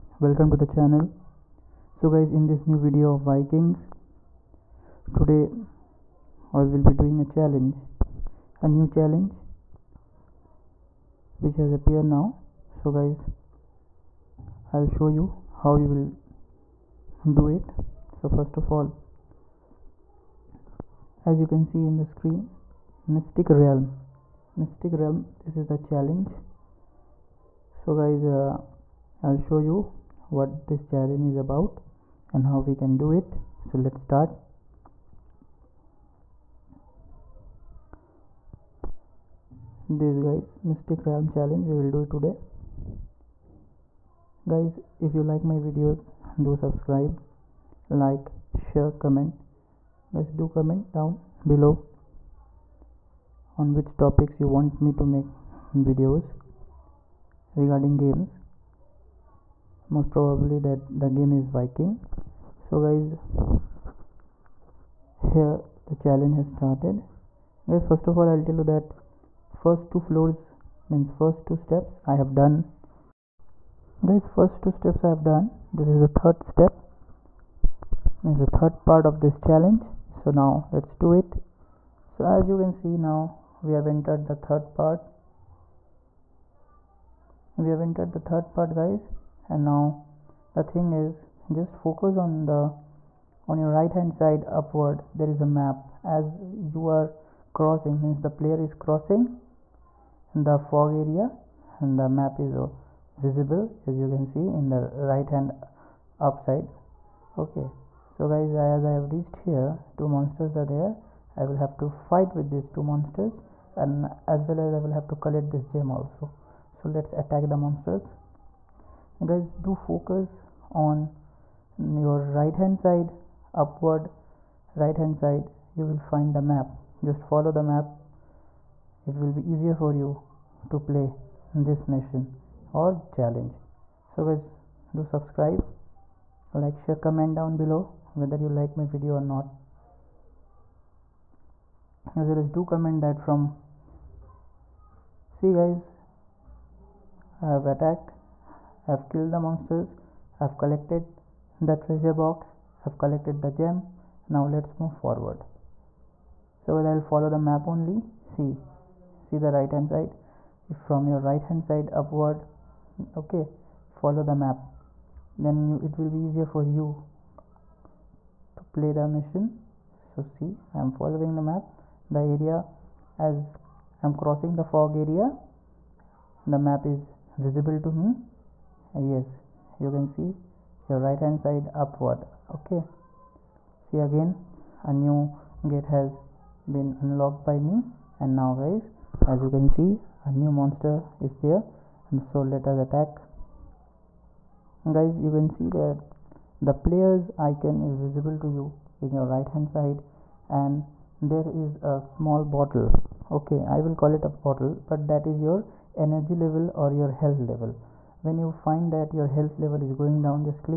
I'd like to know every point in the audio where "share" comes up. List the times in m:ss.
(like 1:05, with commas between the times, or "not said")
0:48, 2:16.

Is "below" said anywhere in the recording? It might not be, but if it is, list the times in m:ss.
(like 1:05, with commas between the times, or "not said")
0:51, 2:17.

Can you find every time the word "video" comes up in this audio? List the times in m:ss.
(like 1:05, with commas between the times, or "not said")
0:02, 0:45, 0:55, 2:18.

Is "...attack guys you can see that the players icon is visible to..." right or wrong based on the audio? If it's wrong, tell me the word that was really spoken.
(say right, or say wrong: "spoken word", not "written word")
right.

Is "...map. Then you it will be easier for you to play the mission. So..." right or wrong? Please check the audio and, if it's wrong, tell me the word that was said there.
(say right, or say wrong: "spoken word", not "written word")
right.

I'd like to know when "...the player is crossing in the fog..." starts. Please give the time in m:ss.
1:38.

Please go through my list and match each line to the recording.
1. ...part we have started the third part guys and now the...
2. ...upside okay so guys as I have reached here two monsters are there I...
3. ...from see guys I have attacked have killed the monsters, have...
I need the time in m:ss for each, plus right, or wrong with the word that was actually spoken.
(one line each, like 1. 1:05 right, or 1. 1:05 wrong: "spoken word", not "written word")
1. 1:24 wrong: "entered", not "started"
2. 1:46 right
3. 2:23 right.